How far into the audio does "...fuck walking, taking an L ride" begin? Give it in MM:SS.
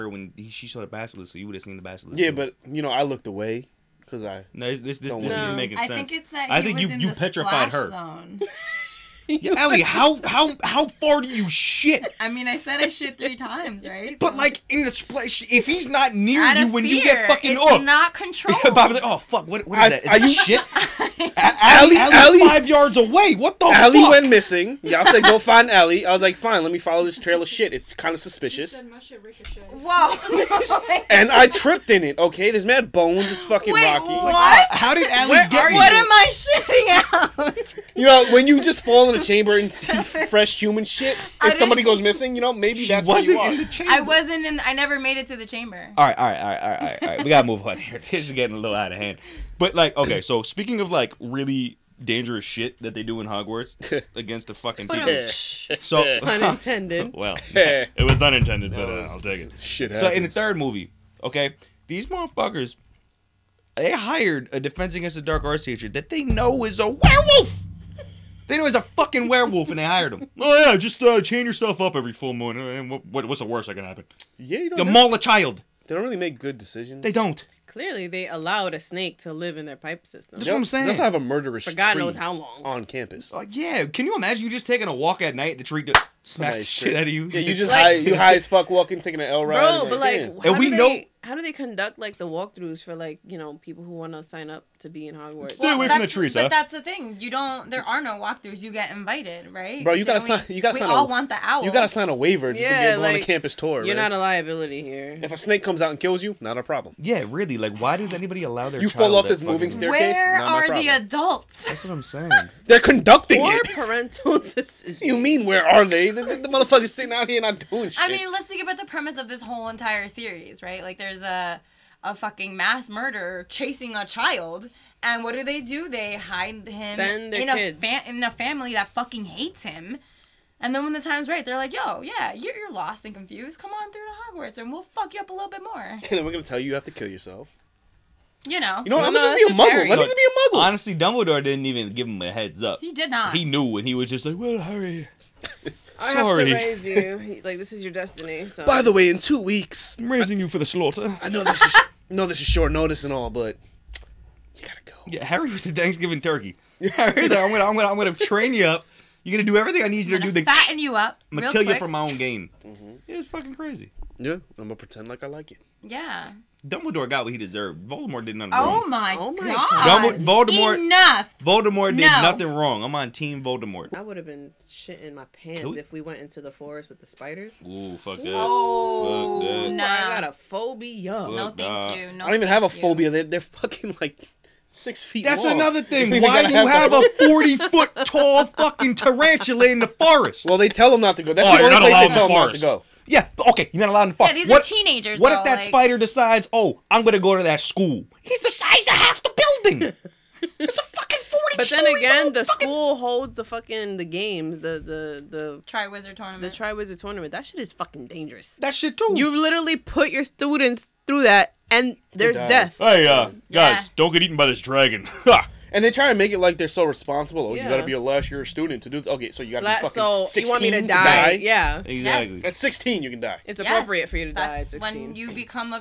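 01:28.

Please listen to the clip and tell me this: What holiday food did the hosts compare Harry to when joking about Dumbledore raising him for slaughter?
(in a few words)
Thanksgiving turkey.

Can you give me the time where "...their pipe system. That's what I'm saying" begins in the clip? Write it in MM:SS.
01:19.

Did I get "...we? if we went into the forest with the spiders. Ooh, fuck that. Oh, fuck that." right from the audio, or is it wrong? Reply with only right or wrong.
right.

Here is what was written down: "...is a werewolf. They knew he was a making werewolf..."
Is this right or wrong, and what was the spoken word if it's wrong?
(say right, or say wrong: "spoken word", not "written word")
wrong: "fucking", not "making".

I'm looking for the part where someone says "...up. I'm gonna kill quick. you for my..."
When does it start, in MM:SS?
02:40.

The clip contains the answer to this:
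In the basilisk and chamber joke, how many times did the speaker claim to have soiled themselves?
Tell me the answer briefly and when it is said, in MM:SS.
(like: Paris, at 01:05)
3, at 00:13.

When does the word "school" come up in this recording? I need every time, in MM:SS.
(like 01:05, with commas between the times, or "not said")
03:17, 03:22.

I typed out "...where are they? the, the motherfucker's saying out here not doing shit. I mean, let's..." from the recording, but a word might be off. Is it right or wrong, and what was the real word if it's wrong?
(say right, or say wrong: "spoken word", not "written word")
wrong: "sitting", not "saying".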